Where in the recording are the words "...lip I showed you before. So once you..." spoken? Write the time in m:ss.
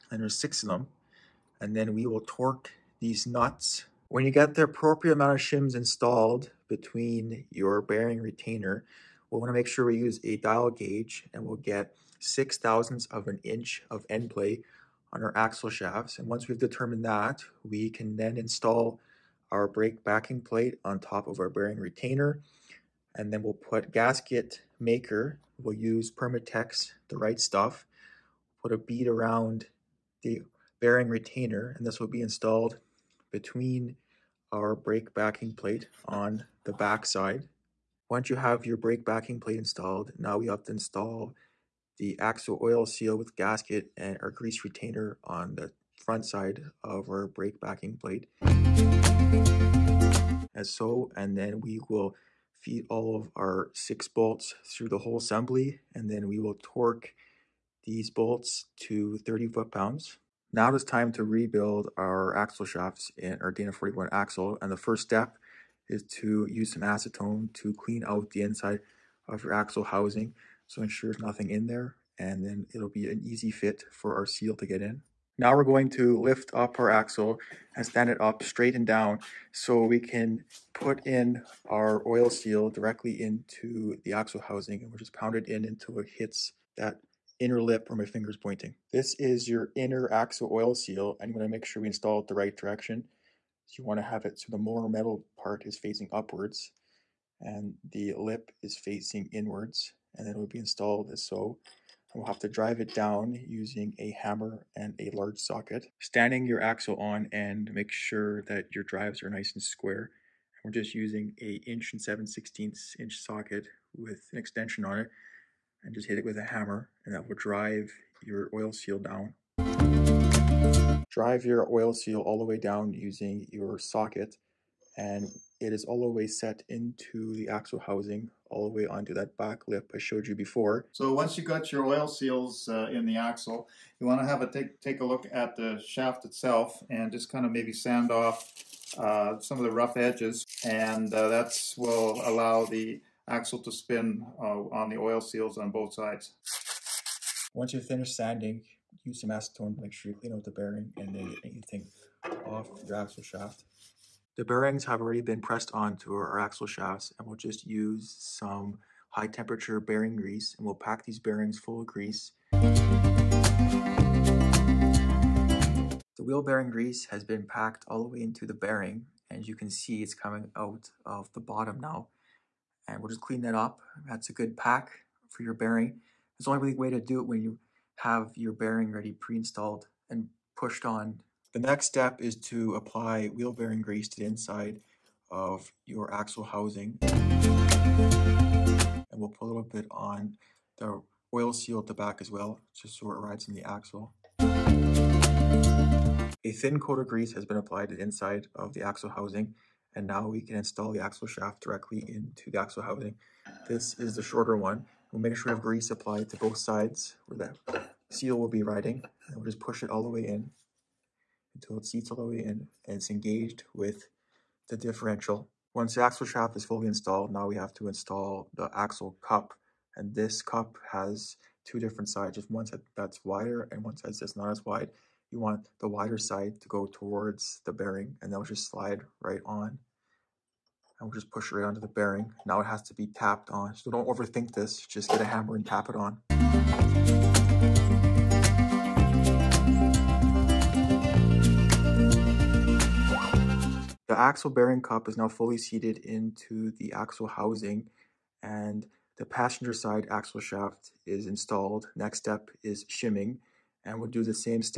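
2:09.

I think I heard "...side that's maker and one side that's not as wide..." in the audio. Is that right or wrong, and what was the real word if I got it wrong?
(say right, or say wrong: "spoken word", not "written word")
wrong: "wider", not "maker".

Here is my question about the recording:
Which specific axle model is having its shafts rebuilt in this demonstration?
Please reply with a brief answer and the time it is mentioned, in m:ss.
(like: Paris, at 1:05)
Dana 41, at 1:03.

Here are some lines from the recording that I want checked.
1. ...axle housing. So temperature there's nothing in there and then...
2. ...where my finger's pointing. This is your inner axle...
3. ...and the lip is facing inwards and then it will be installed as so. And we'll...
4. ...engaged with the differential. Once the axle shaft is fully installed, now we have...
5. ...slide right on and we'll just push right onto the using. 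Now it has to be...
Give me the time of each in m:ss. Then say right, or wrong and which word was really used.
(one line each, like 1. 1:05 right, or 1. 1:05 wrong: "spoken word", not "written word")
1. 1:09 wrong: "ensure", not "temperature"
2. 1:27 right
3. 1:37 right
4. 3:33 right
5. 3:48 wrong: "bearing", not "using".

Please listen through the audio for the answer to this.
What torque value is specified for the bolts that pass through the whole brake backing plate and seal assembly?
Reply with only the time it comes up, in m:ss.
0:59.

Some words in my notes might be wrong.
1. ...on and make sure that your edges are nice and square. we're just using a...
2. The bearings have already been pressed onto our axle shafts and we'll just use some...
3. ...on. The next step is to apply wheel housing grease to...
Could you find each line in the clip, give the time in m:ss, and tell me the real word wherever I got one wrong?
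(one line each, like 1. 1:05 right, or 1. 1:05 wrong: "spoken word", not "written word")
1. 1:46 wrong: "drives", not "edges"
2. 2:34 right
3. 3:00 wrong: "bearing", not "housing".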